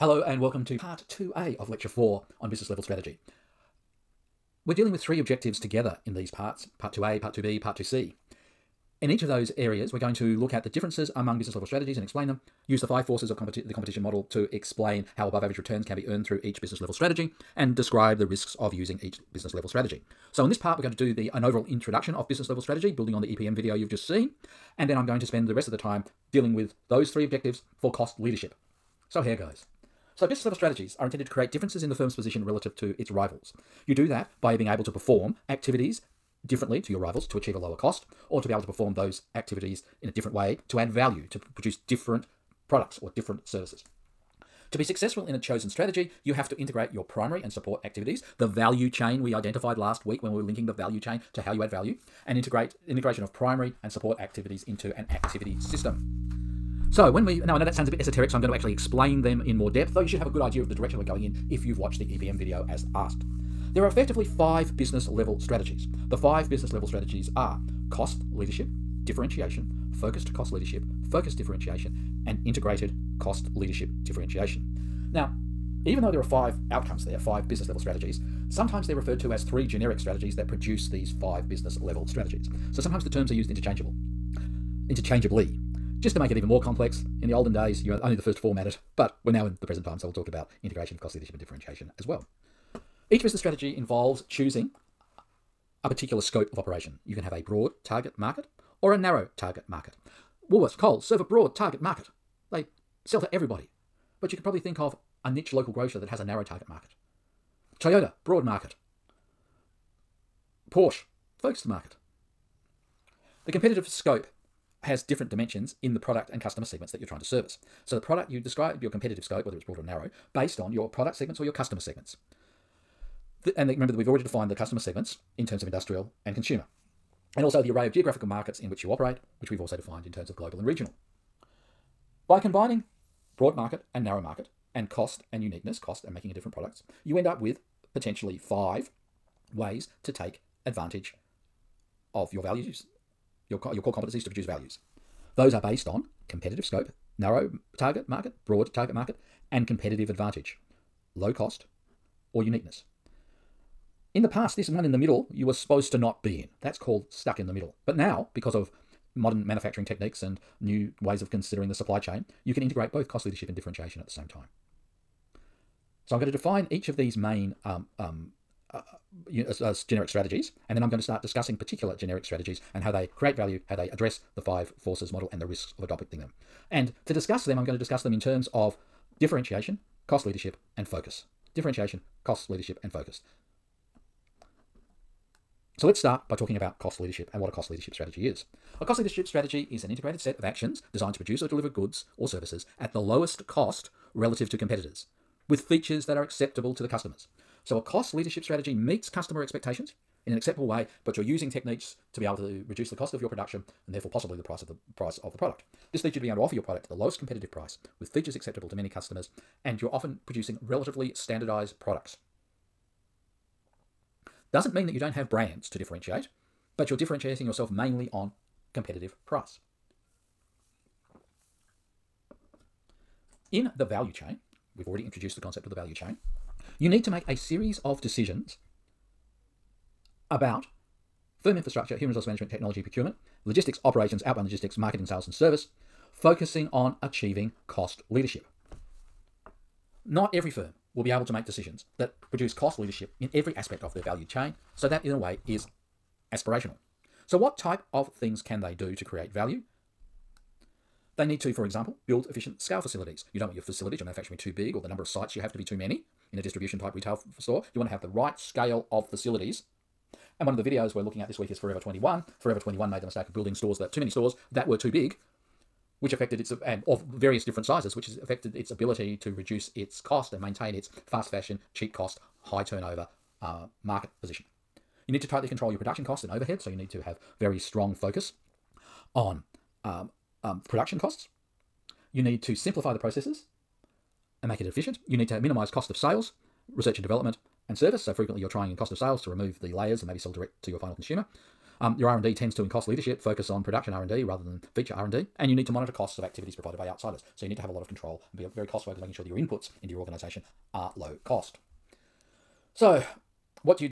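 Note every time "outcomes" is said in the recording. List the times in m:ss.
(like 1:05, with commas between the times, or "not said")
1:16.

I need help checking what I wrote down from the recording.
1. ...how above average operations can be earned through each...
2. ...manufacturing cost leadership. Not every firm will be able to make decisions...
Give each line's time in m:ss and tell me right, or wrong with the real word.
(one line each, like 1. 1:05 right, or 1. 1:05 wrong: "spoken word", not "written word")
1. 0:15 wrong: "returns", not "operations"
2. 3:57 wrong: "achieving", not "manufacturing".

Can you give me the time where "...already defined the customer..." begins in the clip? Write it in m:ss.
2:04.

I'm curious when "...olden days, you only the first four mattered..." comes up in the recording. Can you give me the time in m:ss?
1:27.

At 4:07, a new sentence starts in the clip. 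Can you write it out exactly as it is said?
So, what type of things can they do to create value?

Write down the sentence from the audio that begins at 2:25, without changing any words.
Those are based on competitive scope, narrow target market, broad target market, and competitive advantage, low cost, or uniqueness.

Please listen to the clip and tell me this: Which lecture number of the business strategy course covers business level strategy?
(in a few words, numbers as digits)
4.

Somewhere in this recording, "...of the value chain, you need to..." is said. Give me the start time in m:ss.
3:45.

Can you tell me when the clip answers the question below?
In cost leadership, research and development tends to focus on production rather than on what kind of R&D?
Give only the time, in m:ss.
4:54.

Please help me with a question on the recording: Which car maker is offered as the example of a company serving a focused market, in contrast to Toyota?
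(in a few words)
Porsche.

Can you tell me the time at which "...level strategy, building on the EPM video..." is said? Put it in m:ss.
0:22.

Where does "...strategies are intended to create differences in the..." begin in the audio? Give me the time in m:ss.
0:30.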